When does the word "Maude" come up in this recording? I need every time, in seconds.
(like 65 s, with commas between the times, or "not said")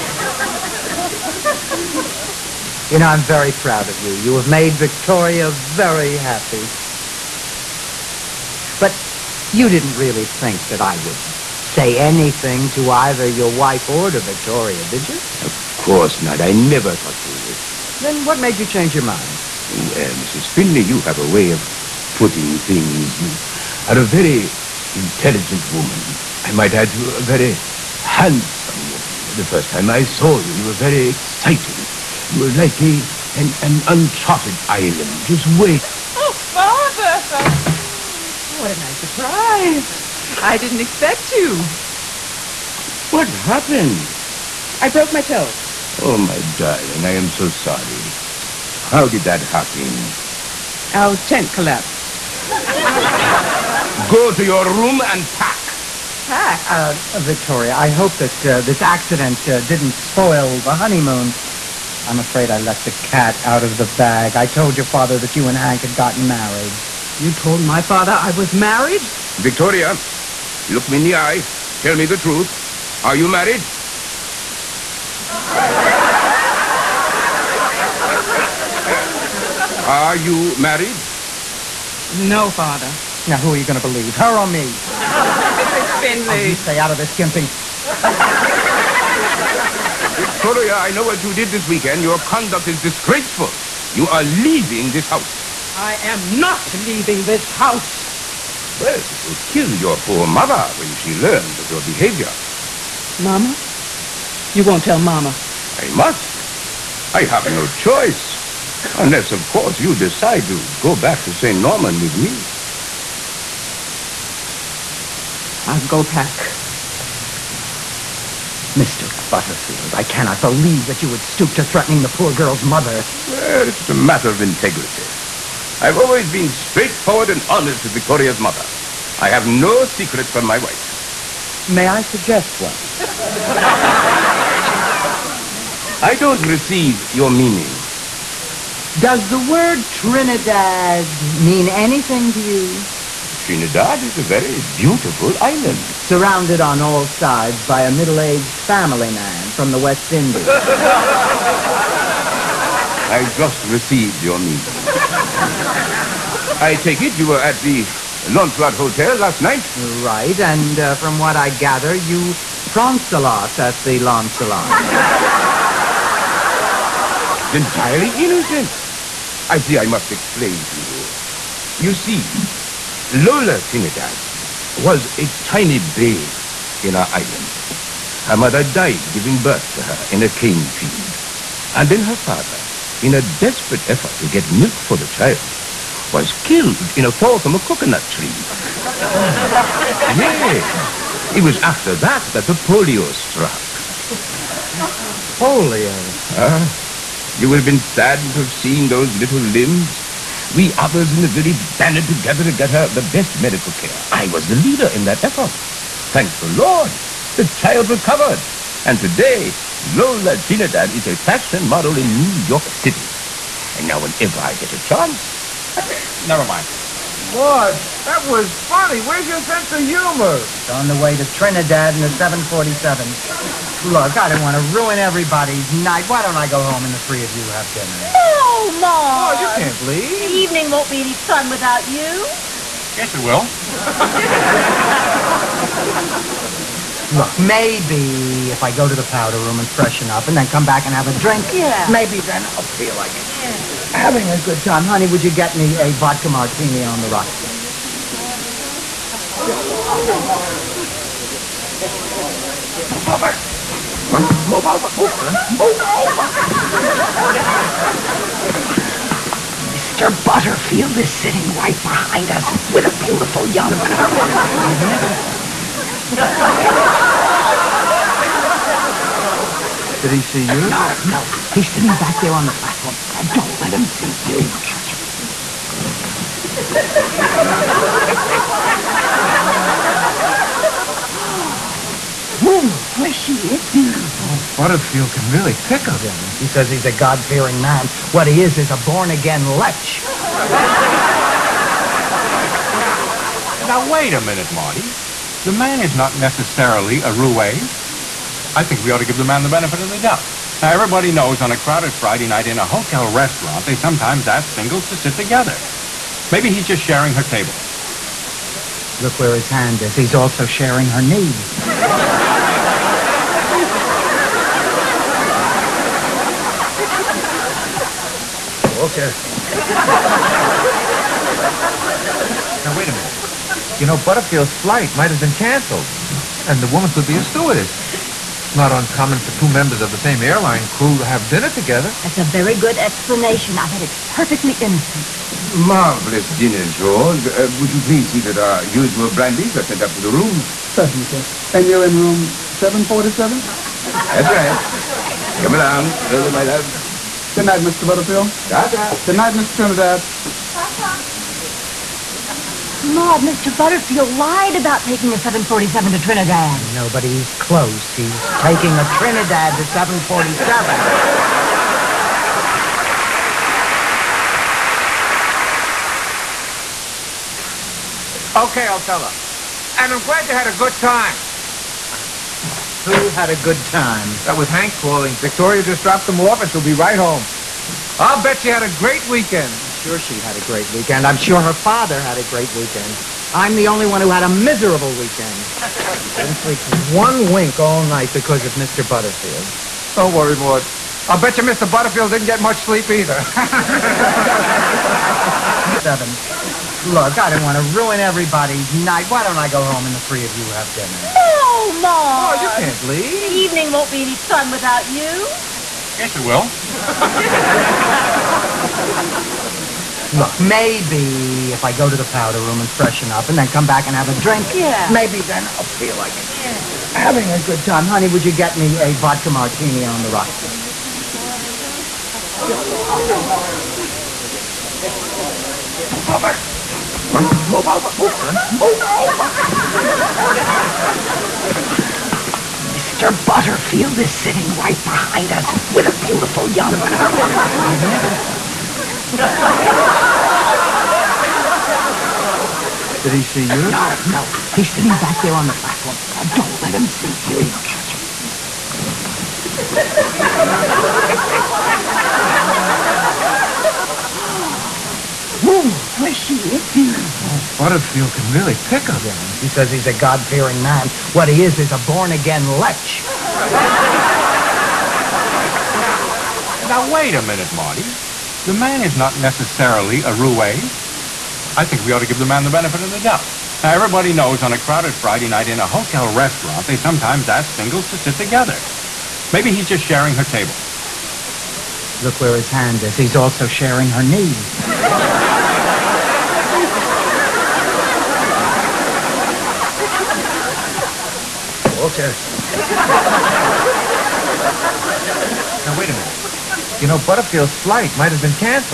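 228 s, 352 s, 390 s.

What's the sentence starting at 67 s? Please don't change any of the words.
You told my father I was married?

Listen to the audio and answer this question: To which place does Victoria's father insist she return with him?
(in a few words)
St. Norman.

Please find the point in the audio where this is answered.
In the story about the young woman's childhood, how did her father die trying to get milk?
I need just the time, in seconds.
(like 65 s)
187 s.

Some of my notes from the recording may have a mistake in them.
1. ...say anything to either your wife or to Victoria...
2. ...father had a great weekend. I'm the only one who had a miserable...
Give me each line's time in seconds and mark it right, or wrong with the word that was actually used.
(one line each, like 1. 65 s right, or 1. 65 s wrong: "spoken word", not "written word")
1. 11 s right
2. 381 s right.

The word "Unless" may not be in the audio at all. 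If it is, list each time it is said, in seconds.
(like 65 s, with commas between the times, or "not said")
108 s.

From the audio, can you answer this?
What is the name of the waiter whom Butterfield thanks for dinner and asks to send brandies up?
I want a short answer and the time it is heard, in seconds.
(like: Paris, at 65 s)
George, at 336 s.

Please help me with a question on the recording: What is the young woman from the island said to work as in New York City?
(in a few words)
Fashion model.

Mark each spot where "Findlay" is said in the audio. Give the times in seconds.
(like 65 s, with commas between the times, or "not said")
20 s.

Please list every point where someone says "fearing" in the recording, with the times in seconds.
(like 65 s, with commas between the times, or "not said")
286 s, 459 s.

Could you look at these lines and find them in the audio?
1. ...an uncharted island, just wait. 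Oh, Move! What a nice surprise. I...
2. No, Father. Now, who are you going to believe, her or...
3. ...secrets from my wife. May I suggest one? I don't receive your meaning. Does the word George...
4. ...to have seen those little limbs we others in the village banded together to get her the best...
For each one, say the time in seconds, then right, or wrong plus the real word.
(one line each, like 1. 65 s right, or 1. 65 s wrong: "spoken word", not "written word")
1. 33 s wrong: "Father", not "Move"
2. 82 s right
3. 129 s wrong: "Trinidad", not "George"
4. 198 s right.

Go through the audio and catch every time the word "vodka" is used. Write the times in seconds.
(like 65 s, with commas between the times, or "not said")
245 s, 418 s.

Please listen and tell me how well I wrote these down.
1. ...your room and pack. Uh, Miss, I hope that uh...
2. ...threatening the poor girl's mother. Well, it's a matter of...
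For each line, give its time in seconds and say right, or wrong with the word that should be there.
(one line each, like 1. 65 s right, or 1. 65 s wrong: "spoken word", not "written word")
1. 54 s wrong: "Victoria", not "Miss"
2. 121 s right.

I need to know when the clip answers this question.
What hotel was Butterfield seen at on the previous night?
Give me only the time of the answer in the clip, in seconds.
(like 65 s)
158 s.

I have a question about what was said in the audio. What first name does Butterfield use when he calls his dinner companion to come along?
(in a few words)
Hilda.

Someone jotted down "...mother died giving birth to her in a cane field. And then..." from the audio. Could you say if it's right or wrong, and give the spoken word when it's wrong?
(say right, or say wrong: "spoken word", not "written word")
right.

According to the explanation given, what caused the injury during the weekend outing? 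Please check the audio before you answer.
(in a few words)
Tent collapsed.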